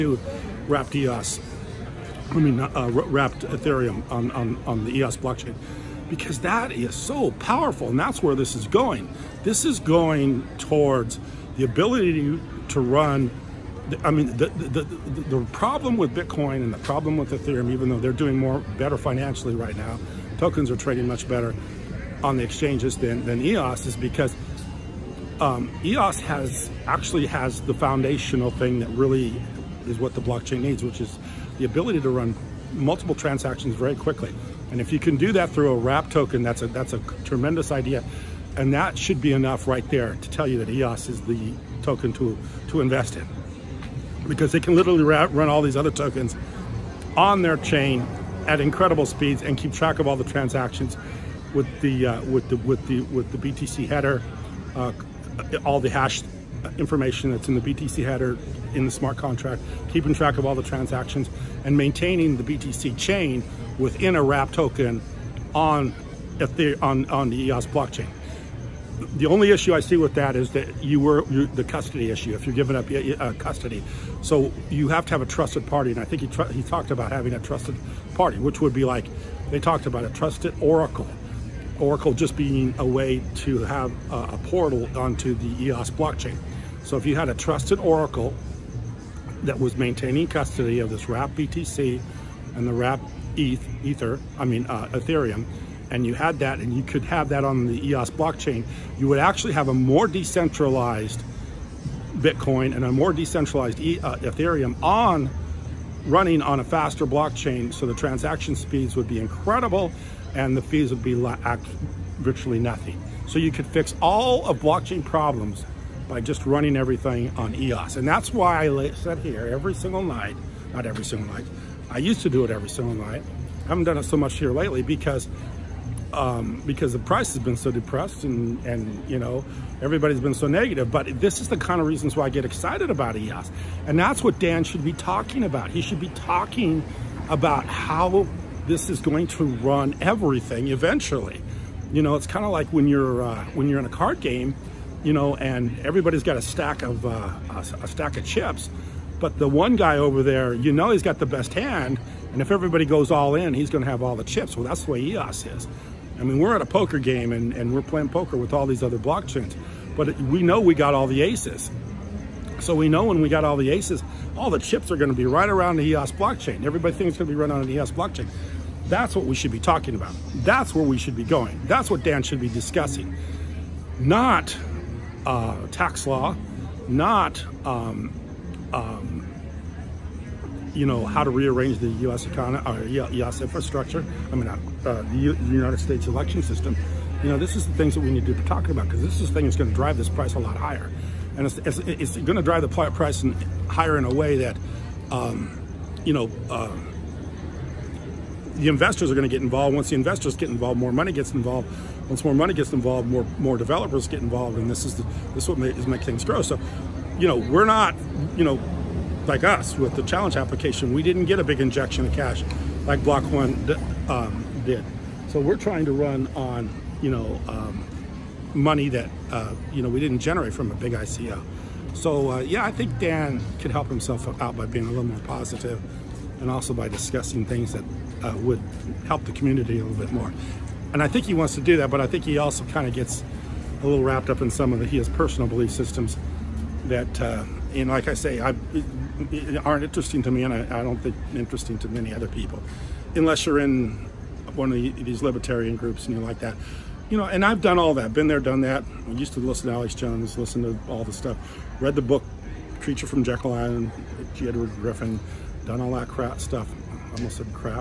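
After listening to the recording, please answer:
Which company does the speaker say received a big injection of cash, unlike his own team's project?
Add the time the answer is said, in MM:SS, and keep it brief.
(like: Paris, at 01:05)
Block One, at 03:33.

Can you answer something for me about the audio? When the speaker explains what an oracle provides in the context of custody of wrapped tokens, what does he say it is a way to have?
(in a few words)
A portal.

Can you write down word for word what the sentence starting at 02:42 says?
So we know when we got all the aces, all the chips are going to be right around the EOS blockchain.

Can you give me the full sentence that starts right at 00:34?
And if you can do that through a wrap token, that's a, that's a tremendous idea.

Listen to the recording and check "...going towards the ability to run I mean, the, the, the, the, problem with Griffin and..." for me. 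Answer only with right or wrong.
wrong.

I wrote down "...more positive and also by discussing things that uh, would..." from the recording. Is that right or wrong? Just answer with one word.
right.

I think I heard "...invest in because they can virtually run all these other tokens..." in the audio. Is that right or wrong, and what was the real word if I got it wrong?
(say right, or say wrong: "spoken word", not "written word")
wrong: "literally", not "virtually".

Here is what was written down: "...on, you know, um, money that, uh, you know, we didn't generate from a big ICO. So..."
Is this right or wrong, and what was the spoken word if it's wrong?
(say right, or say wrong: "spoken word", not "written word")
right.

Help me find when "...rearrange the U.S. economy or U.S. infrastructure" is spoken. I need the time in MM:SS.
03:01.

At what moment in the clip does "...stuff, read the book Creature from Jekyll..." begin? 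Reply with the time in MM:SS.
04:11.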